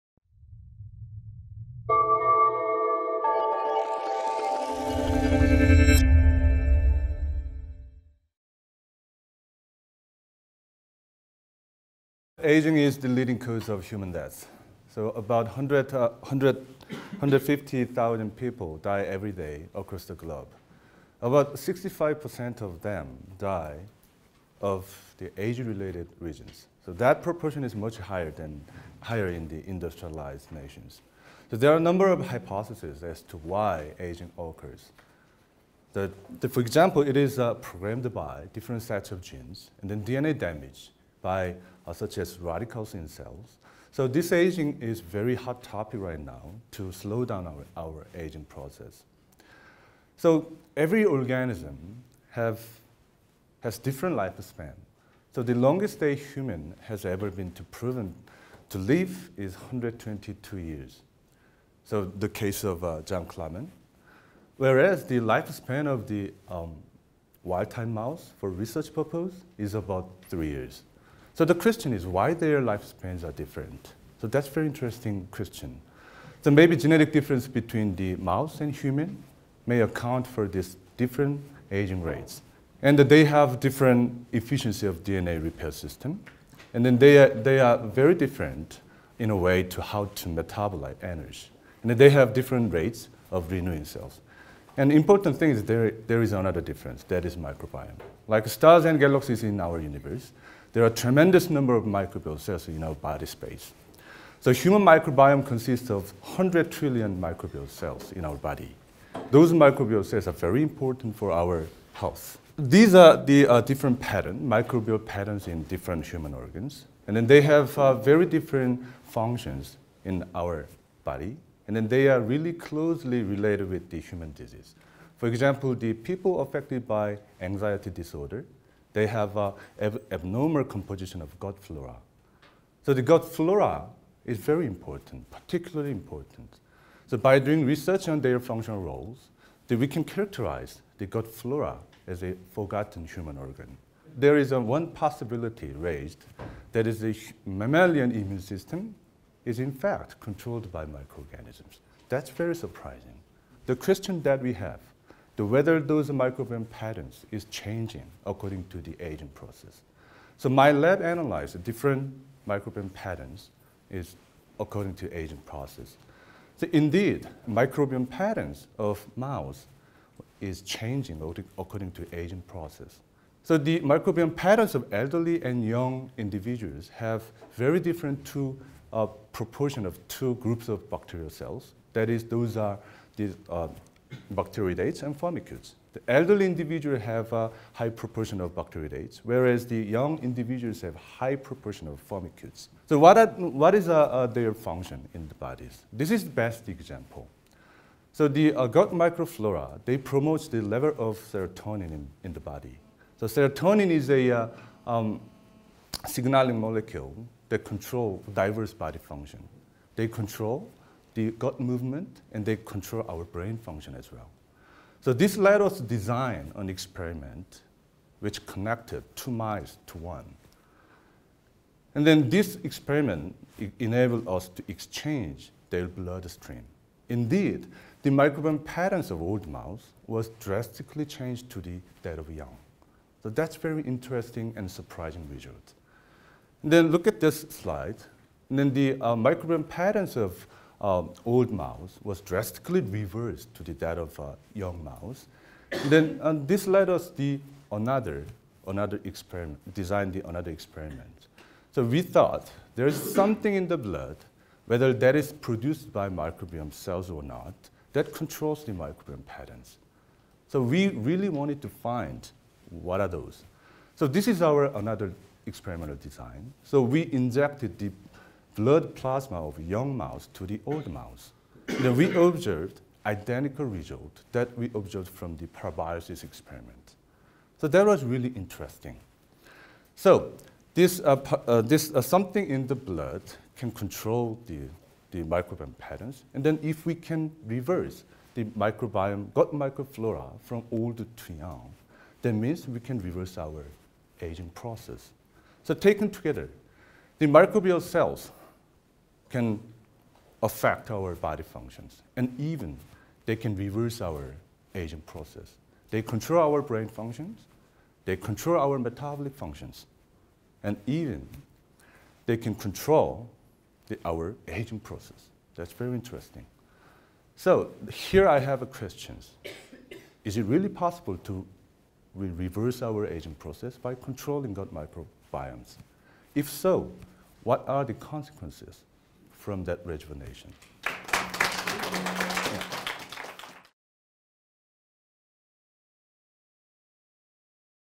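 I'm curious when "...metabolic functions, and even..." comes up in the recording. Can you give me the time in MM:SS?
05:08.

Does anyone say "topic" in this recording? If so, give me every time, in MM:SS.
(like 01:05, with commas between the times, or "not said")
00:45.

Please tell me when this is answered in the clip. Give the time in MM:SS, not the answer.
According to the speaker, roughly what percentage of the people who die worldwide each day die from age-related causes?
00:21.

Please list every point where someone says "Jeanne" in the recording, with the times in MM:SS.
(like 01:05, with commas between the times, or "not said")
01:03.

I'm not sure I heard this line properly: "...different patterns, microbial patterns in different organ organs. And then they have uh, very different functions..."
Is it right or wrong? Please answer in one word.
wrong.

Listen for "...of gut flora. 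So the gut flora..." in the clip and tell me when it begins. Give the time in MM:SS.
02:11.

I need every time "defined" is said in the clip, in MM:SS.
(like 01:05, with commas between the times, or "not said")
not said.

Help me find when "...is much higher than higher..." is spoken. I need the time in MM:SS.
00:27.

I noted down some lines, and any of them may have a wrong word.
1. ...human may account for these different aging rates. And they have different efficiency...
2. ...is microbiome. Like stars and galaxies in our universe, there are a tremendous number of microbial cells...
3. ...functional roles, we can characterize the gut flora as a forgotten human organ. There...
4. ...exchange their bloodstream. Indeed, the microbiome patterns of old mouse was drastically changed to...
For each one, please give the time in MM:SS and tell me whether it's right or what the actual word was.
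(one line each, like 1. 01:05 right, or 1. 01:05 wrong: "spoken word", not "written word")
1. 01:18 right
2. 01:37 right
3. 02:18 right
4. 03:44 right.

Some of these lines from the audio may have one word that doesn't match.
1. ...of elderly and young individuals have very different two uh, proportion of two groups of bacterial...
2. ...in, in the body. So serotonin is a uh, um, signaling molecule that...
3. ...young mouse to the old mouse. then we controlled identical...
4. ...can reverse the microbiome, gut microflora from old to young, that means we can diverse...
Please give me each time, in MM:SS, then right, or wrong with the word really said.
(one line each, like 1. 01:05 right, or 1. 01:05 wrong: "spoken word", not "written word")
1. 02:54 right
2. 03:21 right
3. 04:29 wrong: "observed", not "controlled"
4. 04:46 wrong: "reverse", not "diverse".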